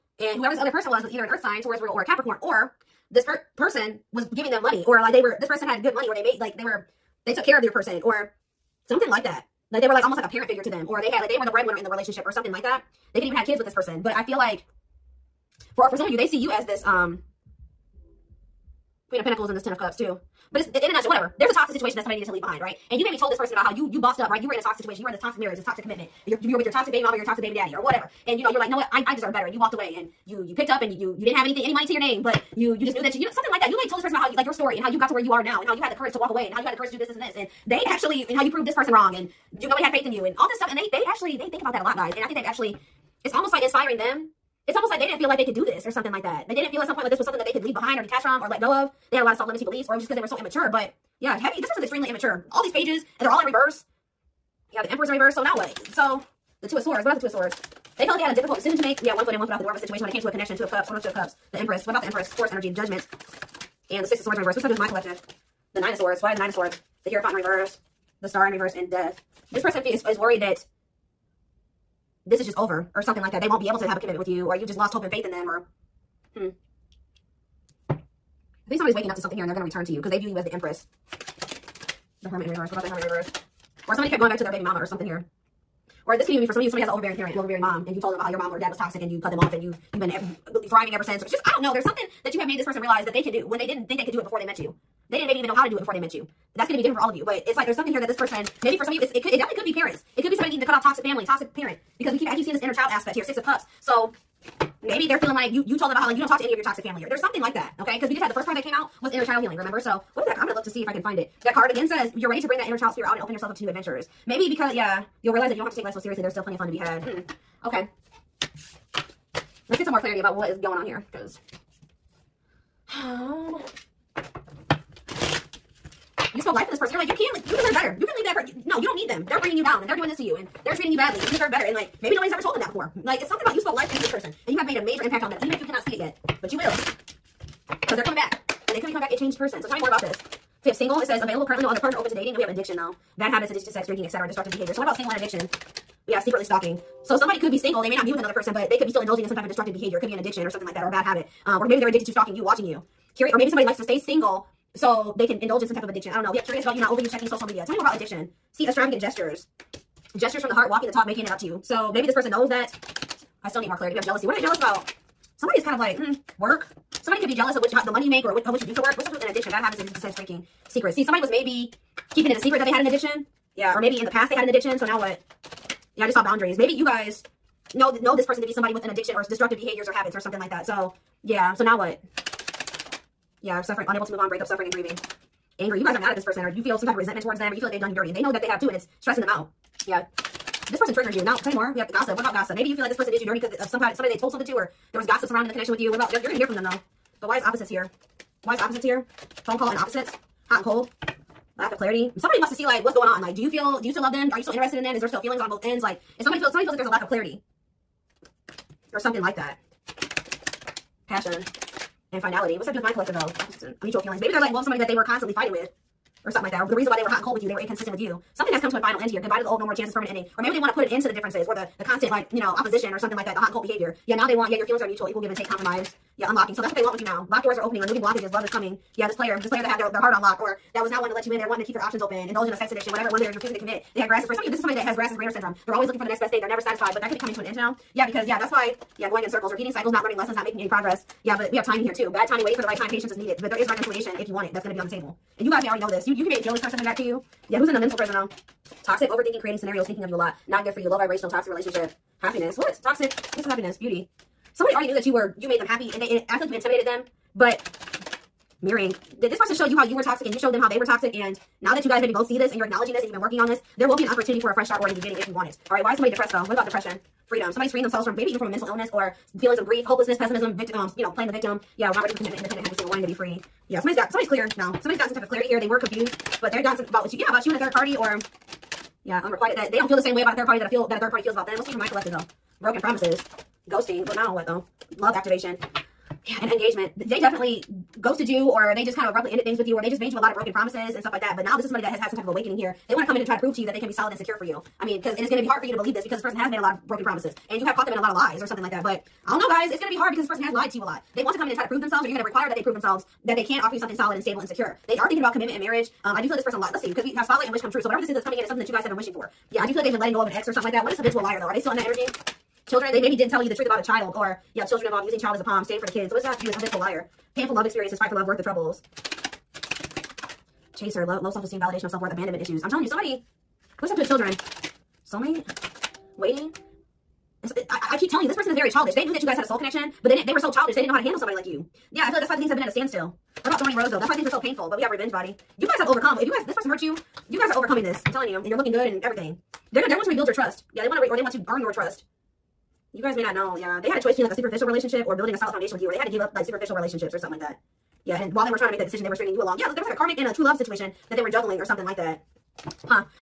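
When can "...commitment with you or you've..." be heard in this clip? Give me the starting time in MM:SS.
01:13.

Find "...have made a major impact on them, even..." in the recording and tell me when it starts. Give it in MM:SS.
02:14.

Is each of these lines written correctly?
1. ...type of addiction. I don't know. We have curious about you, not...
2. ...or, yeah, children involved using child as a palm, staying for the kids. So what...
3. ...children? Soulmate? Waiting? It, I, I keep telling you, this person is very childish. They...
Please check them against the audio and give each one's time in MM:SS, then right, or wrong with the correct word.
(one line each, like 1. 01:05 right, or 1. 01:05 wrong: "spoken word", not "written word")
1. 02:35 right
2. 05:14 right
3. 05:24 right.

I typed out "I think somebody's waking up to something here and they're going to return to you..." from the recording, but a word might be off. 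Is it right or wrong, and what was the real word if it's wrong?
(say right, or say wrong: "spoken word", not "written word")
right.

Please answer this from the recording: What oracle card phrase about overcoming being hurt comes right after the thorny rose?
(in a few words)
Revenge Body.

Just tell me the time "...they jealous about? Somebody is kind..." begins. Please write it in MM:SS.
02:44.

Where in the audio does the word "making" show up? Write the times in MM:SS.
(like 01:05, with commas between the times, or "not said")
02:41, 04:00.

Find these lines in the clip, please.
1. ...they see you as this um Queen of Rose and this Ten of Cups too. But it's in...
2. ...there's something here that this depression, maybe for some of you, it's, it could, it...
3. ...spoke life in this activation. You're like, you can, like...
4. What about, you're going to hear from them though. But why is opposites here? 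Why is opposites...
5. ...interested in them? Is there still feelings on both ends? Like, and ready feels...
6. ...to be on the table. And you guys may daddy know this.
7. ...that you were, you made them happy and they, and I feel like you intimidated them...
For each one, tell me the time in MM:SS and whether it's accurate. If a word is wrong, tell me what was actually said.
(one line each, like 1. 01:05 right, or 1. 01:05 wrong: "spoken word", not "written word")
1. 00:16 wrong: "Pentacles", not "Rose"
2. 01:37 wrong: "person", not "depression"
3. 02:06 wrong: "person", not "activation"
4. 03:15 right
5. 03:24 wrong: "somebody", not "ready"
6. 04:04 wrong: "already", not "daddy"
7. 04:14 right.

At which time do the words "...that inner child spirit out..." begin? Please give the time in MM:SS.
01:52.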